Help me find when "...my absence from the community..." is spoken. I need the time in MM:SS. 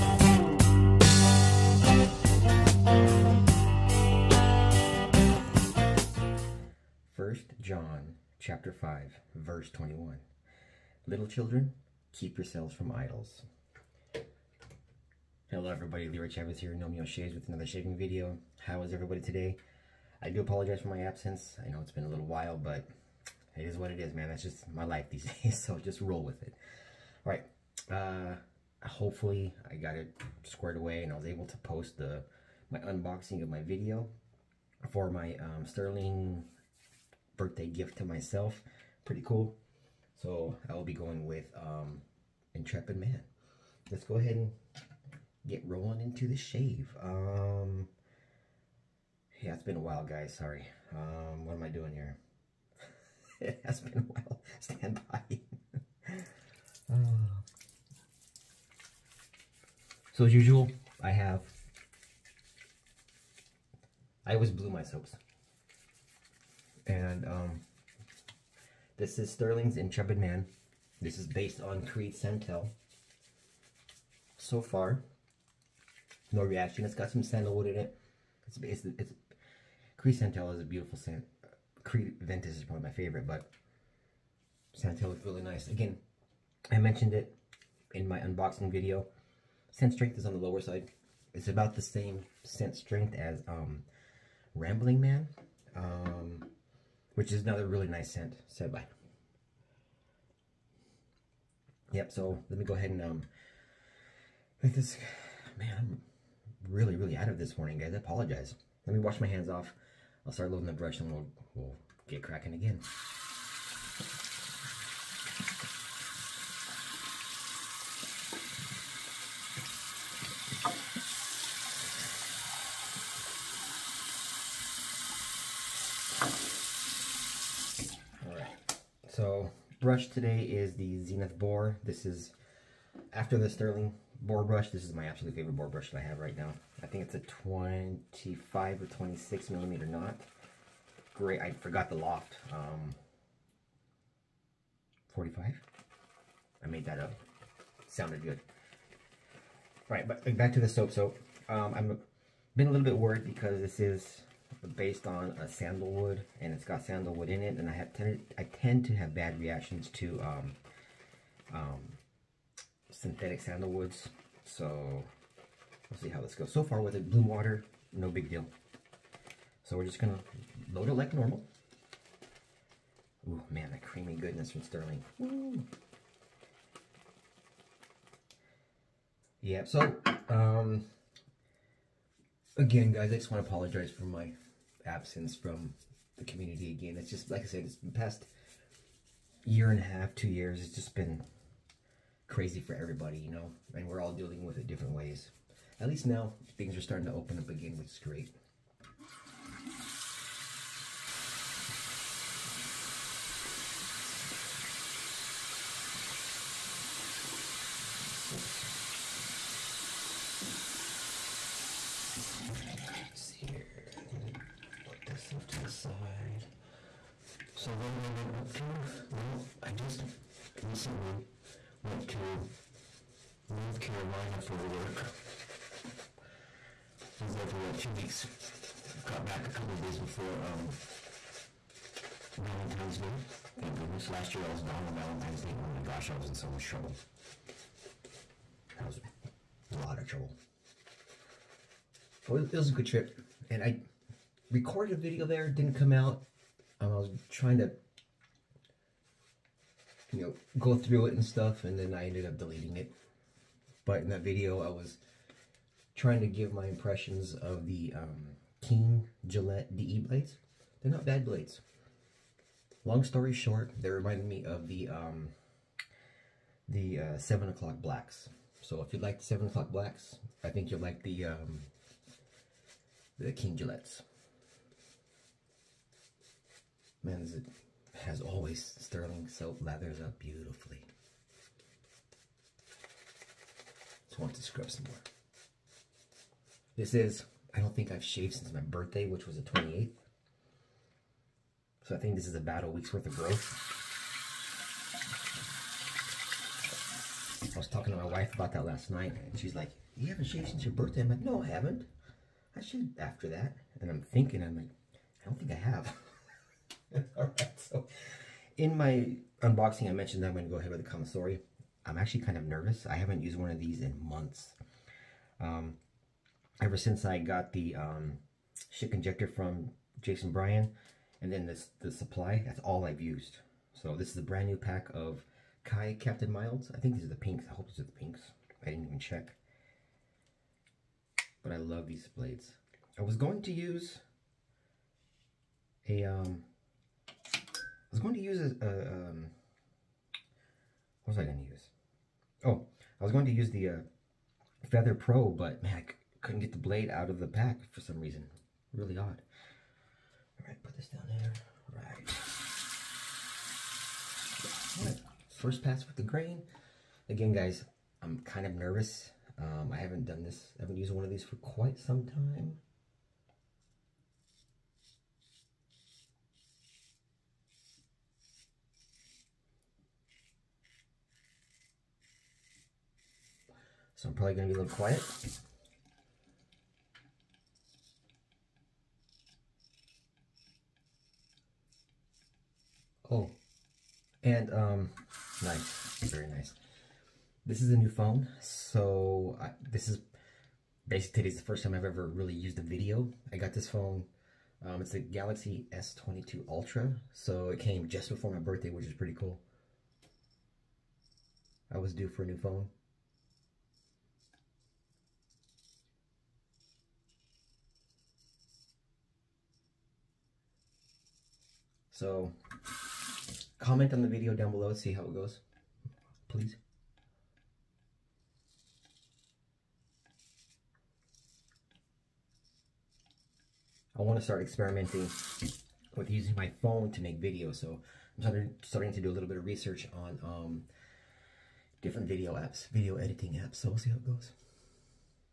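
03:04.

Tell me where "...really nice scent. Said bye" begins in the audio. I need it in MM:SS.
01:37.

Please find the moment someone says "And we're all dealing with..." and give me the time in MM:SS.
03:13.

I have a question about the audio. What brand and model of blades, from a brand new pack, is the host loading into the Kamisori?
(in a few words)
Kai Captain Milds.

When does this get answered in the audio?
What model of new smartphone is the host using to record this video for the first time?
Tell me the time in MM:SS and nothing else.
06:34.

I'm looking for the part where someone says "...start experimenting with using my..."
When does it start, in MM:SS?
07:04.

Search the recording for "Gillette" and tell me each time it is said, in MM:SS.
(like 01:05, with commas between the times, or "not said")
04:19, 04:33.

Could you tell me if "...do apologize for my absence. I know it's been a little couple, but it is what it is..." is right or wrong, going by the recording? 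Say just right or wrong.
wrong.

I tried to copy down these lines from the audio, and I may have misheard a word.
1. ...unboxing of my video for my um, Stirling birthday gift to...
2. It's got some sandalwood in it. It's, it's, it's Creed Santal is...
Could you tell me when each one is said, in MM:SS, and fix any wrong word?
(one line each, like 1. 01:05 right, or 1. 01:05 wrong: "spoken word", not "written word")
1. 00:32 right
2. 01:16 right.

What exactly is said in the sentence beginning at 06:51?
So comment on the video down below, see how it goes, please.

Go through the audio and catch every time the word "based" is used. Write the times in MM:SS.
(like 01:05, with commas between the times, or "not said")
01:11, 02:34.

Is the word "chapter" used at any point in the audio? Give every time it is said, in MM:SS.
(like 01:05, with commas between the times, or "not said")
00:08.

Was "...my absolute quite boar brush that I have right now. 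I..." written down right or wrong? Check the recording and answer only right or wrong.
wrong.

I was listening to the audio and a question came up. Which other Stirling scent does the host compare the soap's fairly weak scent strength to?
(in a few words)
Rambling Man.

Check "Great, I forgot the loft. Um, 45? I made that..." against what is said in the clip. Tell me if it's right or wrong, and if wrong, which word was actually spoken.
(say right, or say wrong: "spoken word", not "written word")
right.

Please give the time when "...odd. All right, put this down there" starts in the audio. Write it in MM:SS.
05:48.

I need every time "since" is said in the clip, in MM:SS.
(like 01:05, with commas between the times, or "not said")
04:48, 05:00, 05:16.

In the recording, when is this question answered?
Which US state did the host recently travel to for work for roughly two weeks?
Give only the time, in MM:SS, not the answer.
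03:43.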